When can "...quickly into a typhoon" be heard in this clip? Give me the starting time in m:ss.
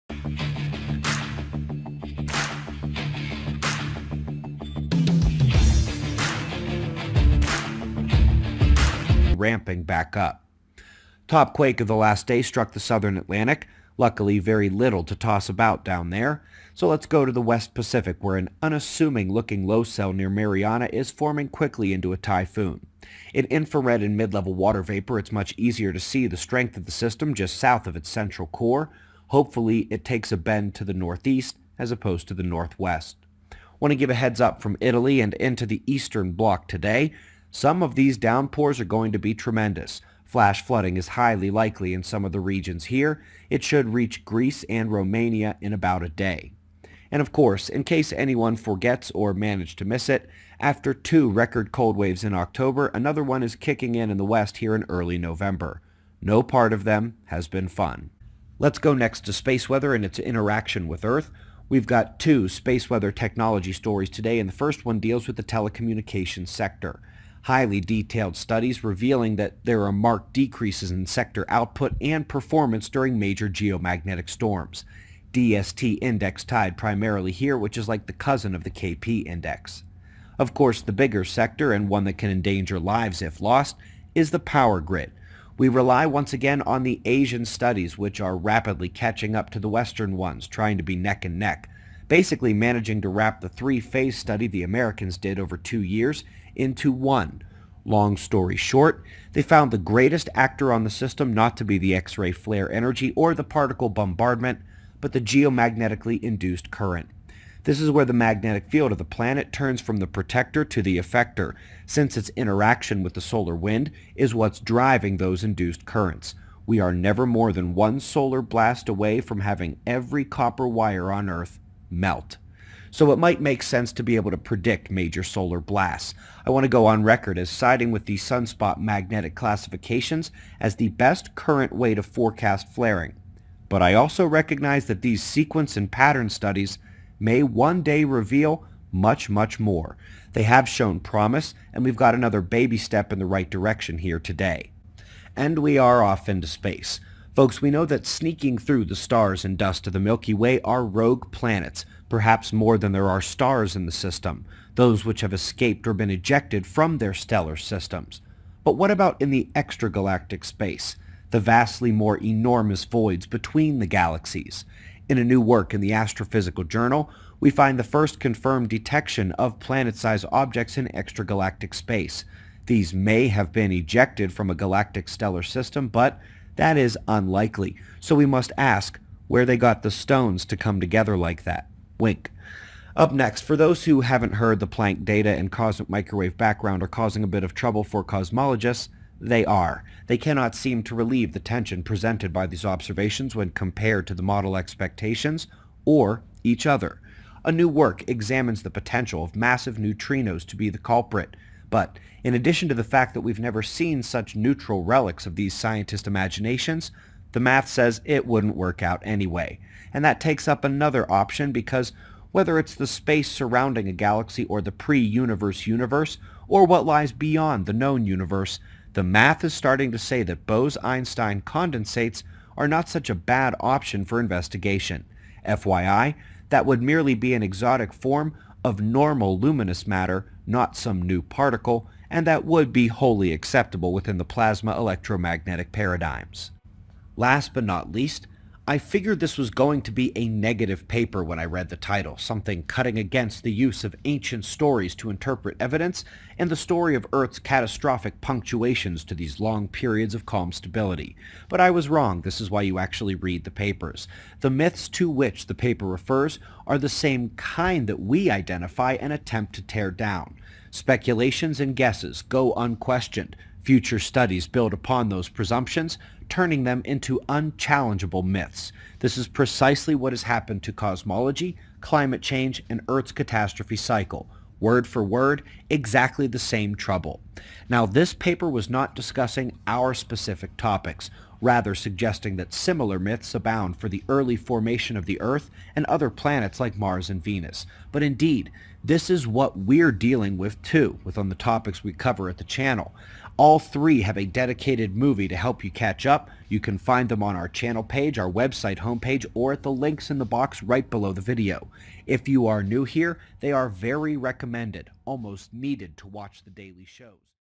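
0:21.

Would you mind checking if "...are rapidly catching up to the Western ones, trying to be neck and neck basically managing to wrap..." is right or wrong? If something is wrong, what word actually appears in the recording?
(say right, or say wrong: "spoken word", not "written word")
right.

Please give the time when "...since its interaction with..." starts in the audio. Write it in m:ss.
1:51.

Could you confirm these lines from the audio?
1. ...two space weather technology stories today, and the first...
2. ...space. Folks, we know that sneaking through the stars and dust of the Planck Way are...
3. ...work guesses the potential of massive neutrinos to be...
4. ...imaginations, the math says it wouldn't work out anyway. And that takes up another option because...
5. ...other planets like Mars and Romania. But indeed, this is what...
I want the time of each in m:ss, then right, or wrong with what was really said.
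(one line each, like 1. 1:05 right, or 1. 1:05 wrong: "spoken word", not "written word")
1. 1:02 right
2. 2:26 wrong: "Milky", not "Planck"
3. 3:17 wrong: "examines", not "guesses"
4. 3:26 right
5. 4:45 wrong: "Venus", not "Romania".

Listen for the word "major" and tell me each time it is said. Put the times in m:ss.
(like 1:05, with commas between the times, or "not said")
1:13, 2:04.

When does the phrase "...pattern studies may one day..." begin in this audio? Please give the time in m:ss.
2:15.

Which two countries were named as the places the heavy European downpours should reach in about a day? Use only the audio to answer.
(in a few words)
Greece and Romania.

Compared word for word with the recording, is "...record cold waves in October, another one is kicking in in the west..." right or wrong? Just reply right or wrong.
right.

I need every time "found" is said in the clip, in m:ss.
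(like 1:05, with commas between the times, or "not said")
1:39.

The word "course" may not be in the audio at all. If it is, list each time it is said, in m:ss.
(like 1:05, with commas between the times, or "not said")
0:47, 1:20.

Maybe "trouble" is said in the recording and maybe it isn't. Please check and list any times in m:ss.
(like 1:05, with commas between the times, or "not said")
3:07, 4:36.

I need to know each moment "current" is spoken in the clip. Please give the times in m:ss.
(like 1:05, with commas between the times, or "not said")
1:46, 1:55, 2:11.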